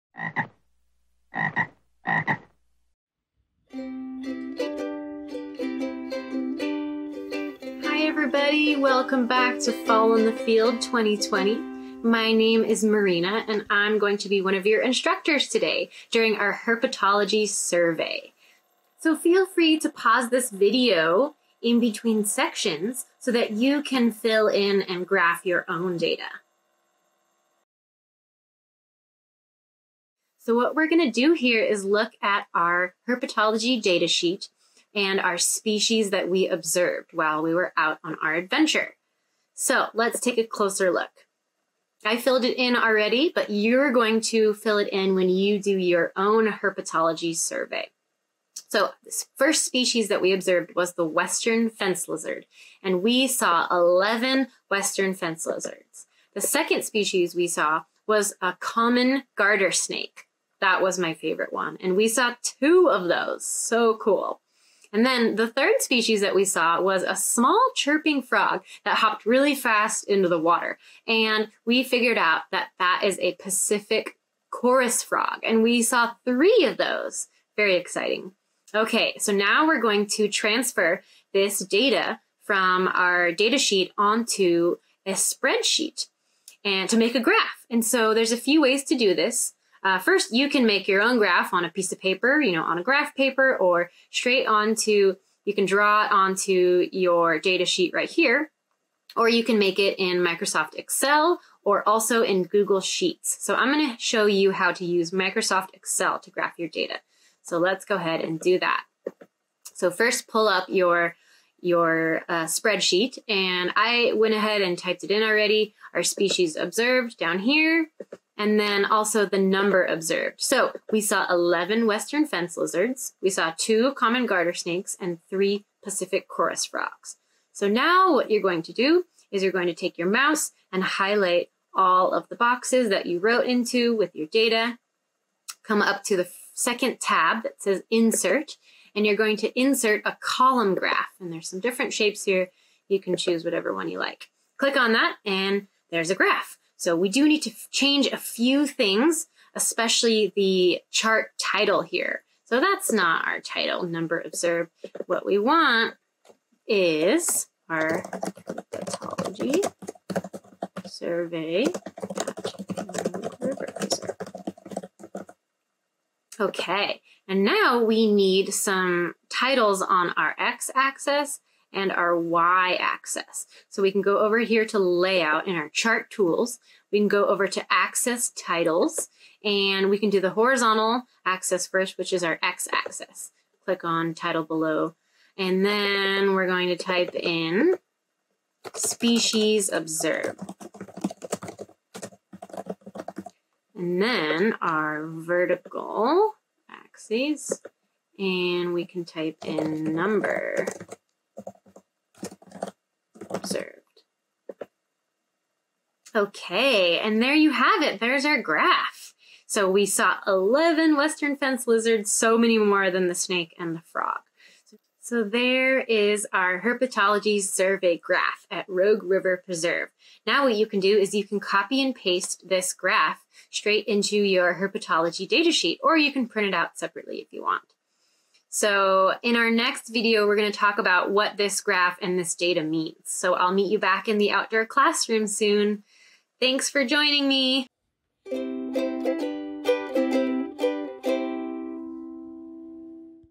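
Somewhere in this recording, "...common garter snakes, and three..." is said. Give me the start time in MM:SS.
02:03.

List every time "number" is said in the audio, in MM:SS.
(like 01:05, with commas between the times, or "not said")
01:59, 02:33, 03:19.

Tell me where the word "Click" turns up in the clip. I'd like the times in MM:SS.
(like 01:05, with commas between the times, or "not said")
02:24, 03:03.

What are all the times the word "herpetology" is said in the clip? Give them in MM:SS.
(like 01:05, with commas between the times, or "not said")
00:16, 00:33, 00:46, 03:36, 03:44.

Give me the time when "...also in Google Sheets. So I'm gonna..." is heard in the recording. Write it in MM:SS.
01:41.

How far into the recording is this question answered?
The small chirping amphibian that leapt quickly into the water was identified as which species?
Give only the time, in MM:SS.
01:13.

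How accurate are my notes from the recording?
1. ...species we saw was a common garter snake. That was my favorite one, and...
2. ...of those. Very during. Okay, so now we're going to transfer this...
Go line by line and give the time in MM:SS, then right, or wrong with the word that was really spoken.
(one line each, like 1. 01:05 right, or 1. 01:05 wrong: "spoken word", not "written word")
1. 00:56 right
2. 01:16 wrong: "exciting", not "during".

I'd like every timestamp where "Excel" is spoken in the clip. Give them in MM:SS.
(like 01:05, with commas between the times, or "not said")
01:40, 01:45.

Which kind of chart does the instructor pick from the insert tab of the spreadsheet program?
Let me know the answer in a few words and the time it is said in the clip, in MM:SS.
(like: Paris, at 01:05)
column graph, at 02:20.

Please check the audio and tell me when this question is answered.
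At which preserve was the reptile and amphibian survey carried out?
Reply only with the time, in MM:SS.
03:38.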